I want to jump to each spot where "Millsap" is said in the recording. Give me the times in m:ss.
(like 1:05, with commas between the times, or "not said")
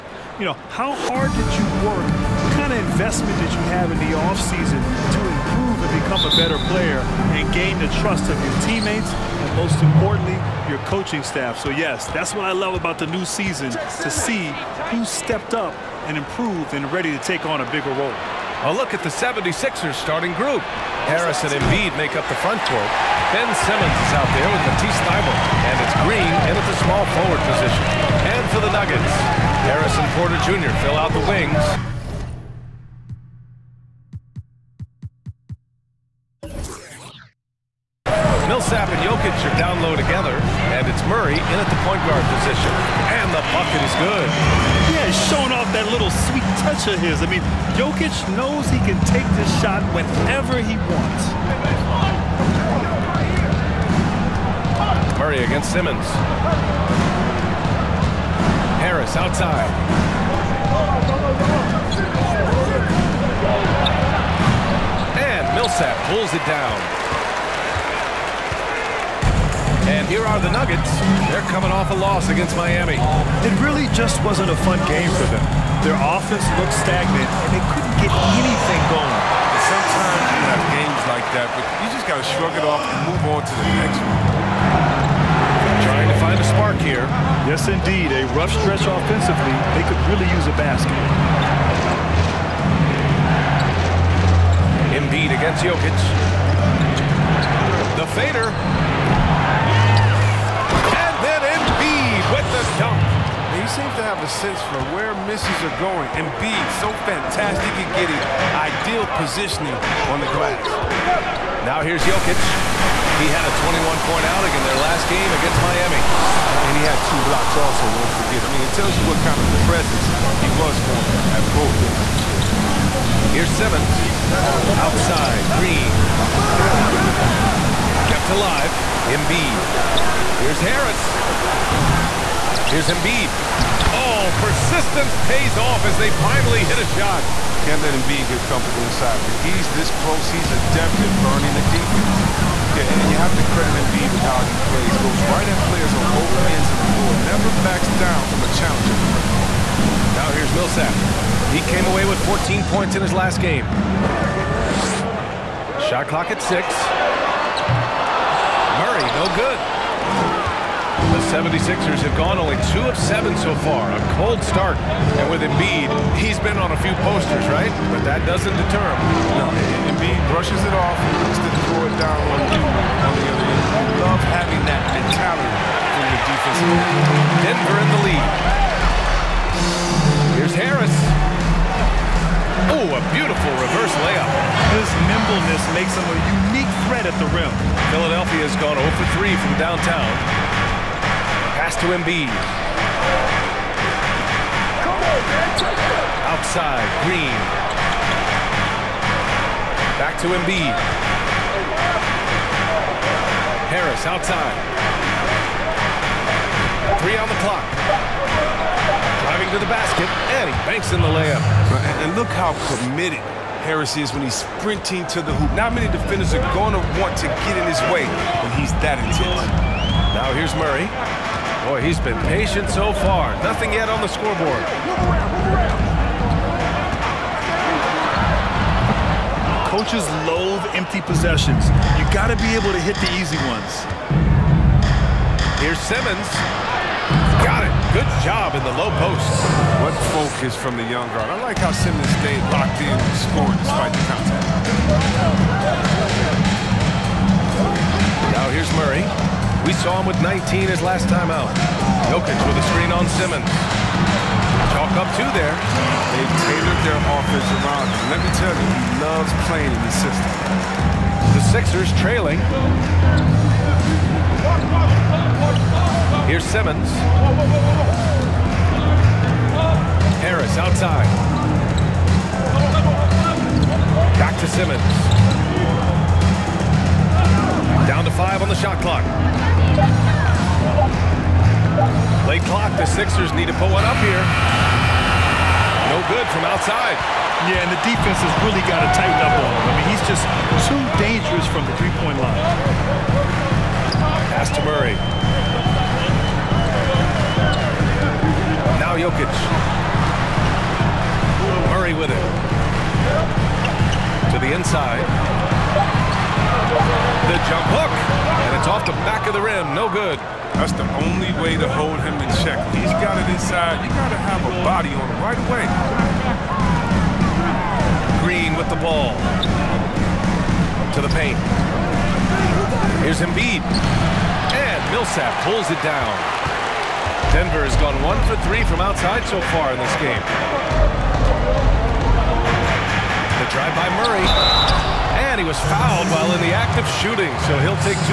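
0:38, 1:05, 2:30, 5:24.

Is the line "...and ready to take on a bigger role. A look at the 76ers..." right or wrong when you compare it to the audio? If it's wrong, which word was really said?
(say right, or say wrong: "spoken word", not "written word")
right.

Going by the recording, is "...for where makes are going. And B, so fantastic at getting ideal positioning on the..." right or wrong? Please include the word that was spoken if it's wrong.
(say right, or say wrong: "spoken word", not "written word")
wrong: "misses", not "makes".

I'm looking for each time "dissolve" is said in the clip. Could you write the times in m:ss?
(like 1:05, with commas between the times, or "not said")
not said.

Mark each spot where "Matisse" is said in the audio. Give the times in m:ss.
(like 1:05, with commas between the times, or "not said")
0:24.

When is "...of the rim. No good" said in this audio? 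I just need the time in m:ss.
5:09.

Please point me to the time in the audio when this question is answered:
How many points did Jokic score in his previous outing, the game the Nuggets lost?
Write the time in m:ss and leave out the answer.
1:53.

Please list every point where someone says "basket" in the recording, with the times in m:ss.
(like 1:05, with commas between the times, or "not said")
1:30, 3:29.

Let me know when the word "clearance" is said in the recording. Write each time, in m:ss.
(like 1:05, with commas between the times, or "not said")
not said.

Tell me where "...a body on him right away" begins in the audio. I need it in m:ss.
5:14.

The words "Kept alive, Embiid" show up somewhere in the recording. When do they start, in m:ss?
2:08.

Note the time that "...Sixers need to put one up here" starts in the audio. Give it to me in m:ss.
4:42.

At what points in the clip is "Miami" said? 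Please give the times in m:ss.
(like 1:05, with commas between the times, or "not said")
1:12, 1:55.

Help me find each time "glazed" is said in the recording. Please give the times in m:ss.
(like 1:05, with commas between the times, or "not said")
not said.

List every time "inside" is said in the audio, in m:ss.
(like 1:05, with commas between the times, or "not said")
2:18, 5:04, 5:13.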